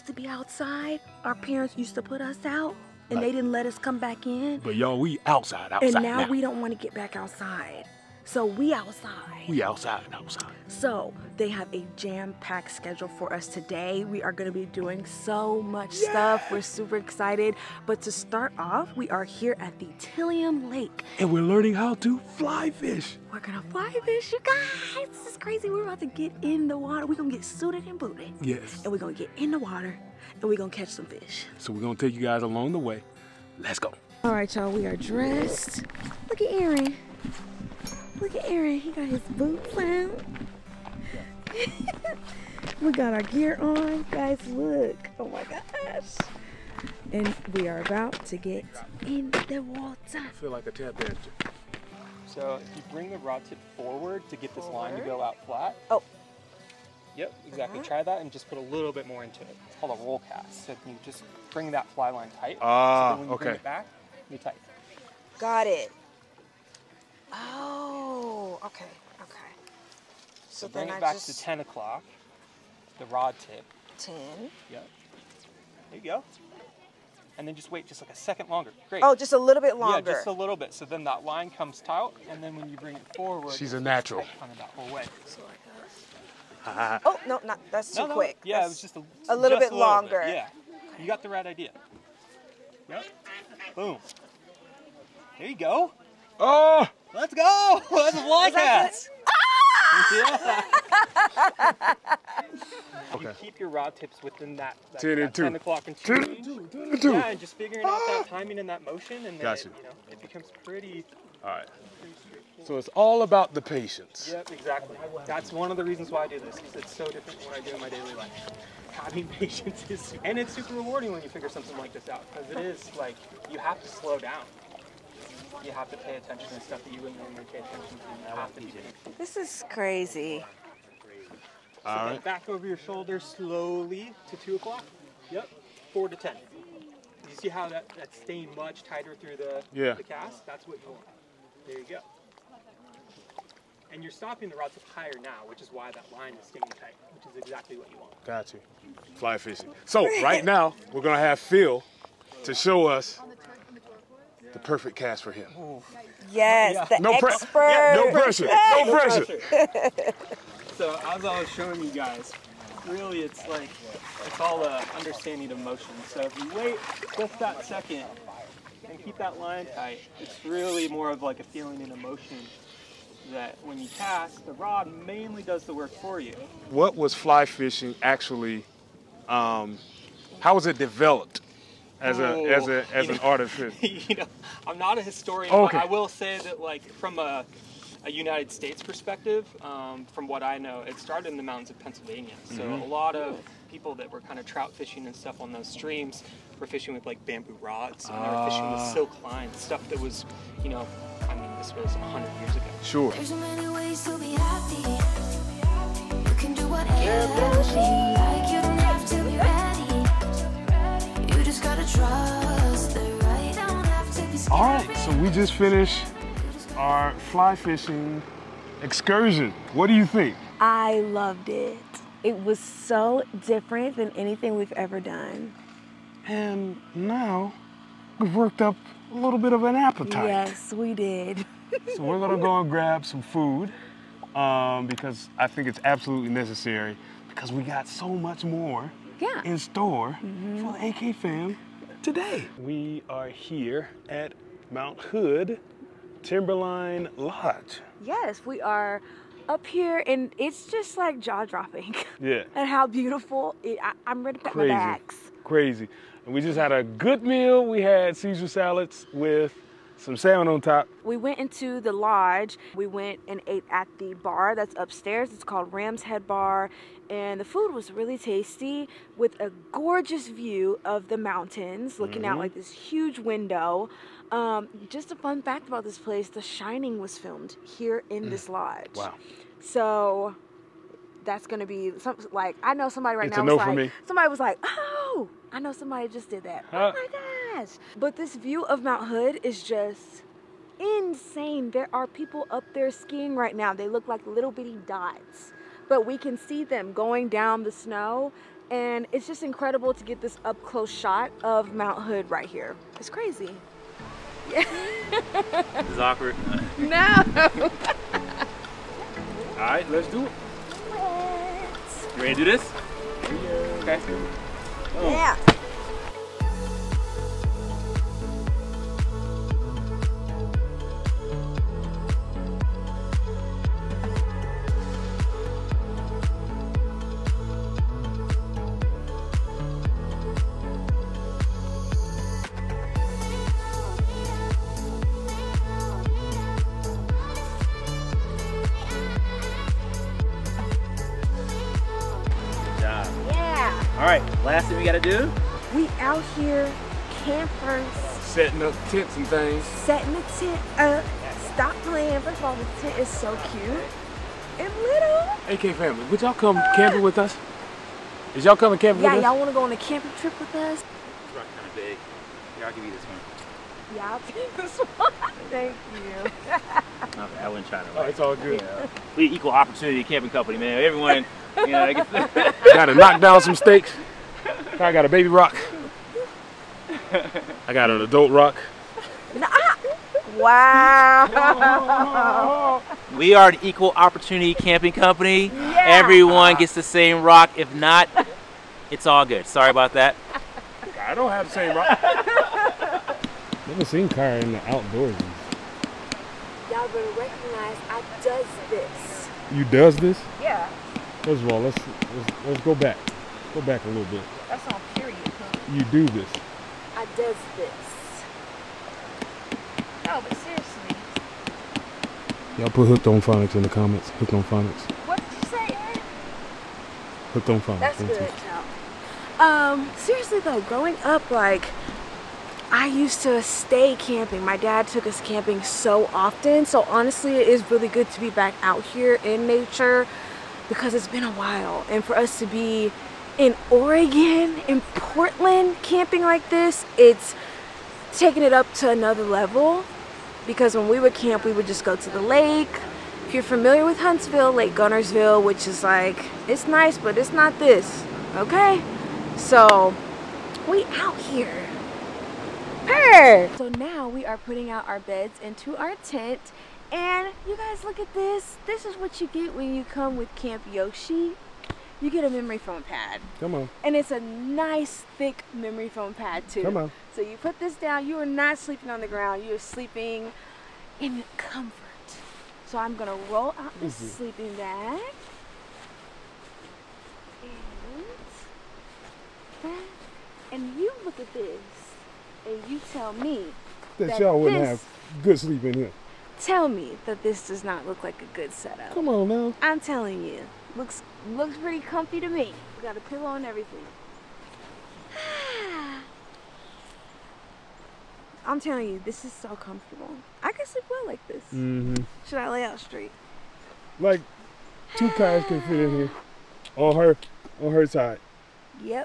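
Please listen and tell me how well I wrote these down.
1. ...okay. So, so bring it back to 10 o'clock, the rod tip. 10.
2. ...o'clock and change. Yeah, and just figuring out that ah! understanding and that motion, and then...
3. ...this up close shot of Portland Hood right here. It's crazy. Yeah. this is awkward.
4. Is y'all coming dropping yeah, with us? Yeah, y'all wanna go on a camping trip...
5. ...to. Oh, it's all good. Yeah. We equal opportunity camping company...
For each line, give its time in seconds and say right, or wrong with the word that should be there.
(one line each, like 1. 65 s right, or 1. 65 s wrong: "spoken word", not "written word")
1. 68 s right
2. 105 s wrong: "timing", not "understanding"
3. 300 s wrong: "Mount", not "Portland"
4. 358 s wrong: "camping", not "dropping"
5. 367 s right.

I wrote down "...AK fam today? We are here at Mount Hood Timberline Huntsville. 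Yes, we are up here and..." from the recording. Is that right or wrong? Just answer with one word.
wrong.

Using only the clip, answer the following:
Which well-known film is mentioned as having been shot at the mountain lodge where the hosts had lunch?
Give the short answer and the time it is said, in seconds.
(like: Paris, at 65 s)
The Shining, at 276 s.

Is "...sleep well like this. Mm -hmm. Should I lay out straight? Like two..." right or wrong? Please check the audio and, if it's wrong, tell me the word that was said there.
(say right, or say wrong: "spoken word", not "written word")
right.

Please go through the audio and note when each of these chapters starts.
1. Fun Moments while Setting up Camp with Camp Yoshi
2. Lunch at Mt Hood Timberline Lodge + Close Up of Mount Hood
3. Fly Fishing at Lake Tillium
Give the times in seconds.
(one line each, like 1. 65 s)
1. 303 s
2. 223 s
3. 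12 s.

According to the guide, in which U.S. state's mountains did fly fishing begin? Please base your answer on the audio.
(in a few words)
Pennsylvania.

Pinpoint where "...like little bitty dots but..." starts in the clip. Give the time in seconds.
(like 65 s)
294 s.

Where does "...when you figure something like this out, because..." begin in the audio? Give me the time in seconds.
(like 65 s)
121 s.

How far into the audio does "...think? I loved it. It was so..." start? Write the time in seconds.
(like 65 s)
220 s.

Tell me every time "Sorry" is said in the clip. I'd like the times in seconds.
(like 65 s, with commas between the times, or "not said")
389 s.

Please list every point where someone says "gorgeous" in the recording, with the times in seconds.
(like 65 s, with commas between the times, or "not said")
269 s.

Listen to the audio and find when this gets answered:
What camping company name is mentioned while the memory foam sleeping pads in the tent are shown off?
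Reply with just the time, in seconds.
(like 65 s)
460 s.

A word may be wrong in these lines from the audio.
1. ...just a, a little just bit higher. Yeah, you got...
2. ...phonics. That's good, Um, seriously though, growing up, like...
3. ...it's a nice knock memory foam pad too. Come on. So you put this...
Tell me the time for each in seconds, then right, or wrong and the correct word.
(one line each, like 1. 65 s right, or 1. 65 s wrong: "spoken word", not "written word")
1. 88 s wrong: "longer", not "higher"
2. 417 s right
3. 463 s wrong: "thick", not "knock".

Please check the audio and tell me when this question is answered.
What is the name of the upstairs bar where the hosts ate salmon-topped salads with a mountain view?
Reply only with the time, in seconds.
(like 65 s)
265 s.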